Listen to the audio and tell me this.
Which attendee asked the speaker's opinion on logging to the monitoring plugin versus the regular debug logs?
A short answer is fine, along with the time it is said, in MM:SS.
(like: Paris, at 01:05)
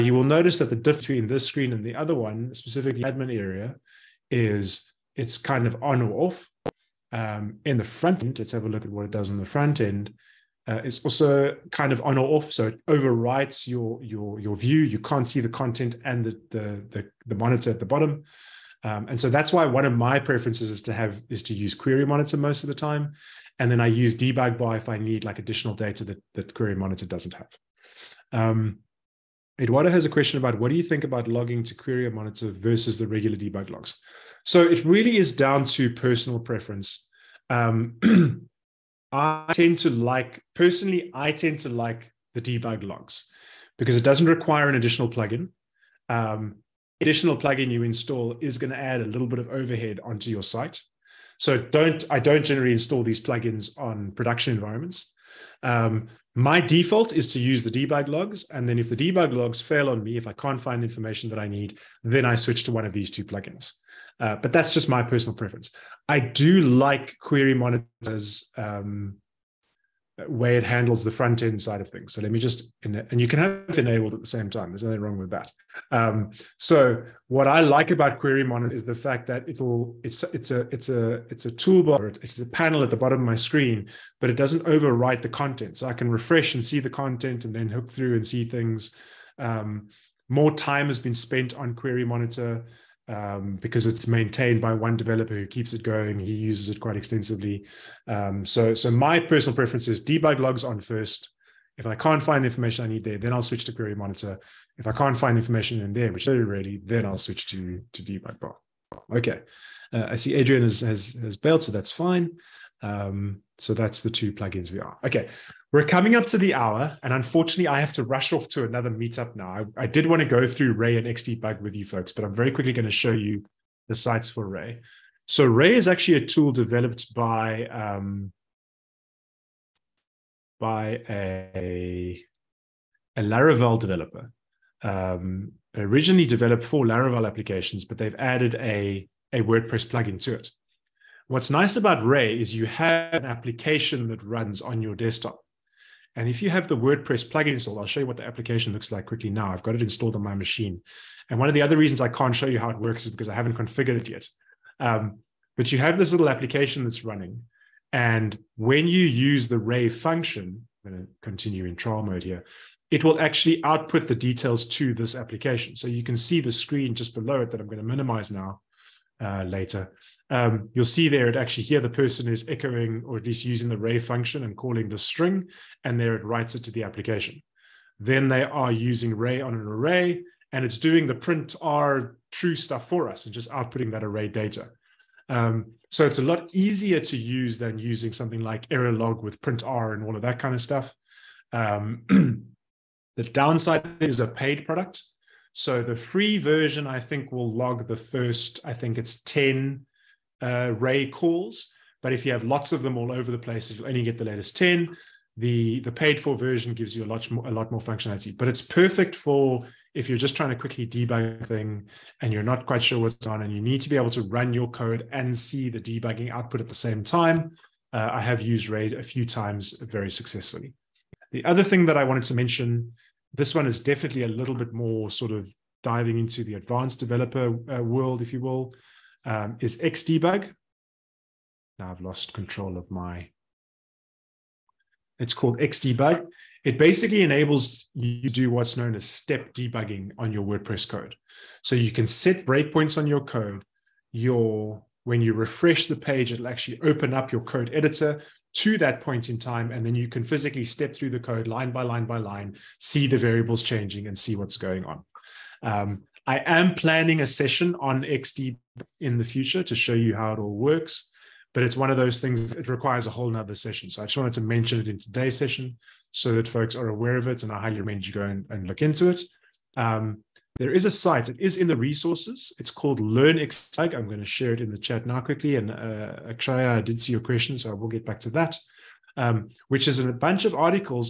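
Eduardo, at 00:29.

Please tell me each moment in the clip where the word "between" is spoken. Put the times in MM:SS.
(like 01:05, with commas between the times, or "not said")
00:01.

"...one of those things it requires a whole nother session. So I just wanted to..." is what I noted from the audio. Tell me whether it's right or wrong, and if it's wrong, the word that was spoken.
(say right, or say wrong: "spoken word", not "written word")
right.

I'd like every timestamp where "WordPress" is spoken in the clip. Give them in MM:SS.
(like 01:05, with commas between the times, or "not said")
02:19, 02:26, 04:00.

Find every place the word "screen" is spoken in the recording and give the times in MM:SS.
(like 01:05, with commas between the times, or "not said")
00:01, 01:23, 02:46.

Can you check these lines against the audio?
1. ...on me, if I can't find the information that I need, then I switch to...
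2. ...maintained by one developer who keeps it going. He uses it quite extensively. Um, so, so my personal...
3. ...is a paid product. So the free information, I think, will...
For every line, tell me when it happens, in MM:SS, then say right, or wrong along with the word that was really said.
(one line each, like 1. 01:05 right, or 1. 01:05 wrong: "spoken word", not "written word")
1. 00:59 right
2. 01:34 right
3. 03:13 wrong: "version", not "information".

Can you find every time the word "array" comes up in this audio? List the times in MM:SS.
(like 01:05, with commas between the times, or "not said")
02:59, 03:04.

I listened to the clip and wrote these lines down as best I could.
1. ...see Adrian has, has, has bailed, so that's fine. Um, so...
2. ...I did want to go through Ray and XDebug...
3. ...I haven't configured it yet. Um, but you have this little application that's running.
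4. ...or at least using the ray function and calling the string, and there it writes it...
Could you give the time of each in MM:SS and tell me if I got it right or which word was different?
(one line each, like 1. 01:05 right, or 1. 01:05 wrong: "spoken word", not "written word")
1. 01:50 right
2. 01:59 right
3. 02:33 right
4. 02:53 right.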